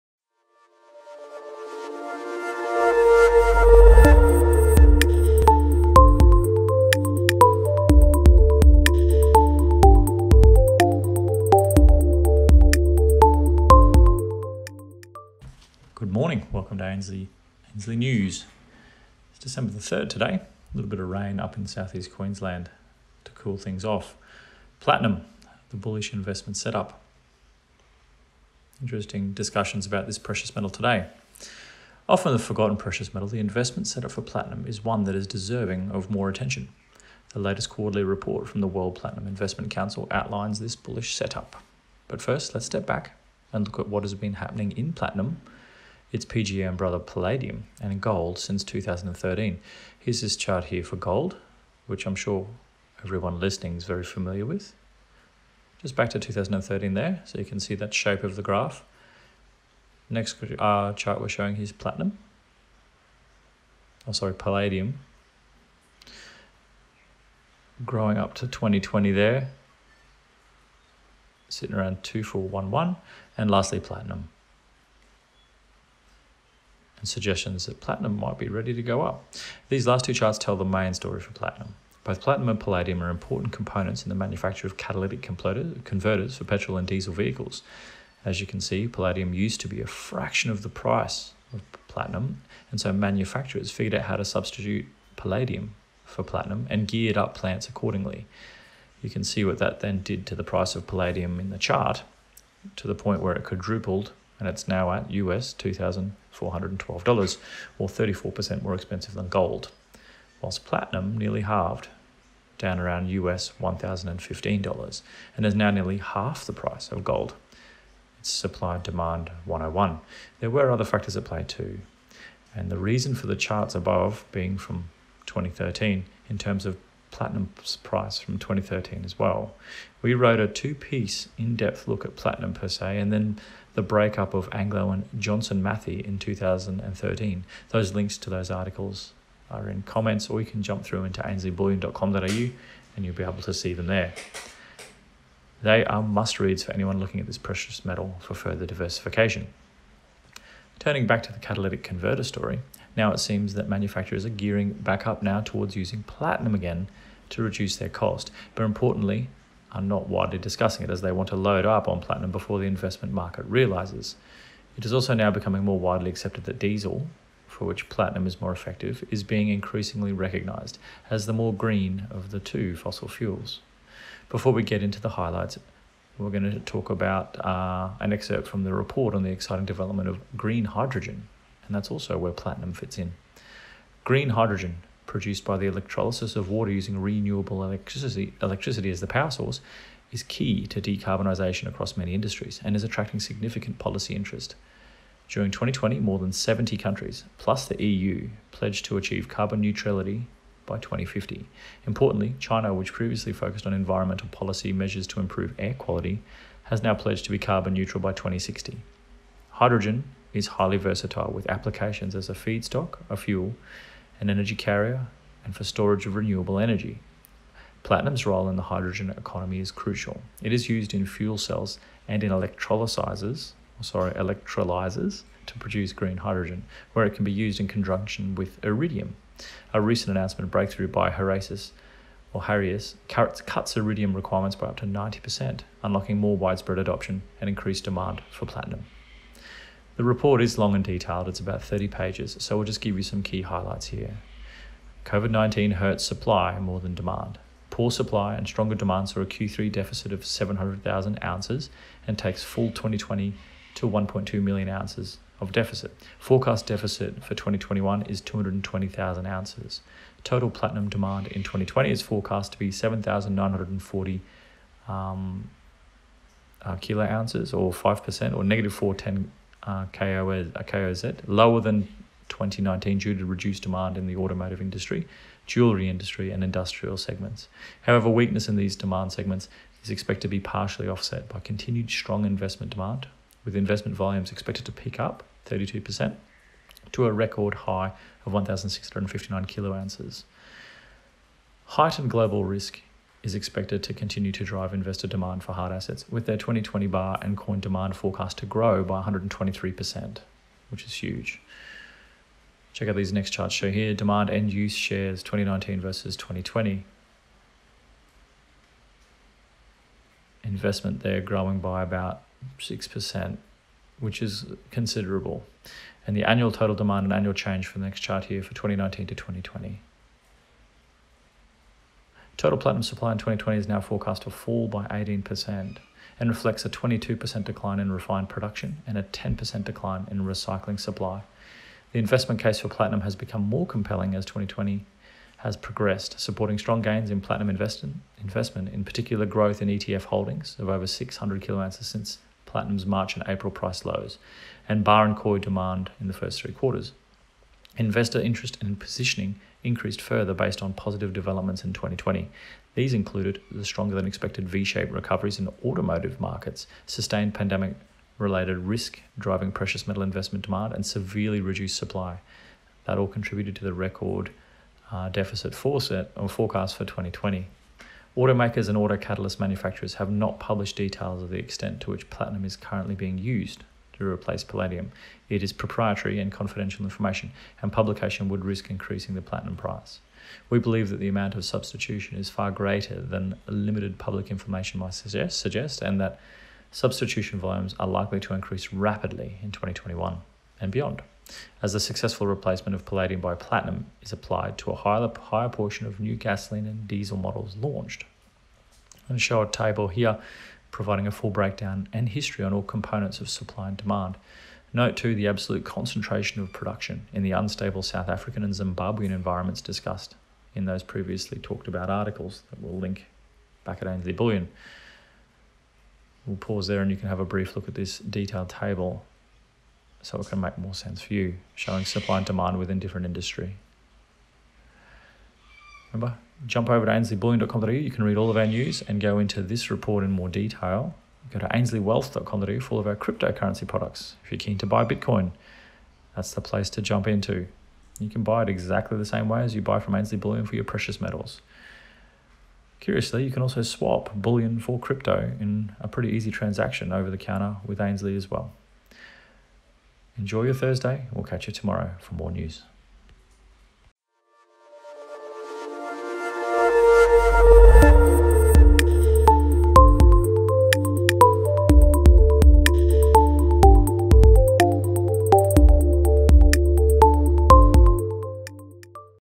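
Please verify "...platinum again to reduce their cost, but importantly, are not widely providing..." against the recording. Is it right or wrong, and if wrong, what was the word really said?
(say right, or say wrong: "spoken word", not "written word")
wrong: "discussing", not "providing".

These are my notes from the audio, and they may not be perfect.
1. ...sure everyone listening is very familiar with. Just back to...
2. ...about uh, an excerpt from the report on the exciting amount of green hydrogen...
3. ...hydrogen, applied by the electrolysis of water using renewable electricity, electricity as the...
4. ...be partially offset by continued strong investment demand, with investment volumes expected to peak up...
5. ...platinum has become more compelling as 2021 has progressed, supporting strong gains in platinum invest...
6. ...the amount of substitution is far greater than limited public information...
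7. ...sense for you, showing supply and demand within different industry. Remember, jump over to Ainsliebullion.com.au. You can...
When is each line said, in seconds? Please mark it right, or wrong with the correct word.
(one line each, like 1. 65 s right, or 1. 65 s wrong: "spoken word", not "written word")
1. 52 s right
2. 176 s wrong: "development", not "amount"
3. 184 s wrong: "produced", not "applied"
4. 280 s right
5. 332 s wrong: "2020", not "2021"
6. 380 s right
7. 420 s right.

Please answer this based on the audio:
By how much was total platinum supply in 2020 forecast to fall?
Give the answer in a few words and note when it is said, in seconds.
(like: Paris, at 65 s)
18%, at 324 s.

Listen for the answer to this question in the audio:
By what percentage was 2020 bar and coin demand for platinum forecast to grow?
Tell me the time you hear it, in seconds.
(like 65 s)
299 s.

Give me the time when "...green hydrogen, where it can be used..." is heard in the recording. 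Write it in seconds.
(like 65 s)
225 s.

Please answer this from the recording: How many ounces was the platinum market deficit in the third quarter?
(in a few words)
700,000 ounces.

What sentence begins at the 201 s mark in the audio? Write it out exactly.
Importantly, China, which previously focused on environmental policy measures to improve air quality, has now pledged to be carbon neutral by 2060.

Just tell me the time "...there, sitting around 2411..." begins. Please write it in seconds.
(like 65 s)
69 s.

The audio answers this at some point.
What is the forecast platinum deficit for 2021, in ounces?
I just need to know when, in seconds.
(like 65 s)
258 s.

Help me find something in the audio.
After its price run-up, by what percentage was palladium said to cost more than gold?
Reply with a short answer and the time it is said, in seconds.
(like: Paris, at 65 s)
34%, at 107 s.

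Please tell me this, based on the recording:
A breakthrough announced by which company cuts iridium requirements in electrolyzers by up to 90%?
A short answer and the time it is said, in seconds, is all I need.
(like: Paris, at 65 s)
Heraeus, at 231 s.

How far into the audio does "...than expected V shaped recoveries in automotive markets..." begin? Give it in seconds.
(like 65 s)
353 s.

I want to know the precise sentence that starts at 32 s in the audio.
Often the forgotten precious metal, the investment setup for platinum is one that is deserving of more attention.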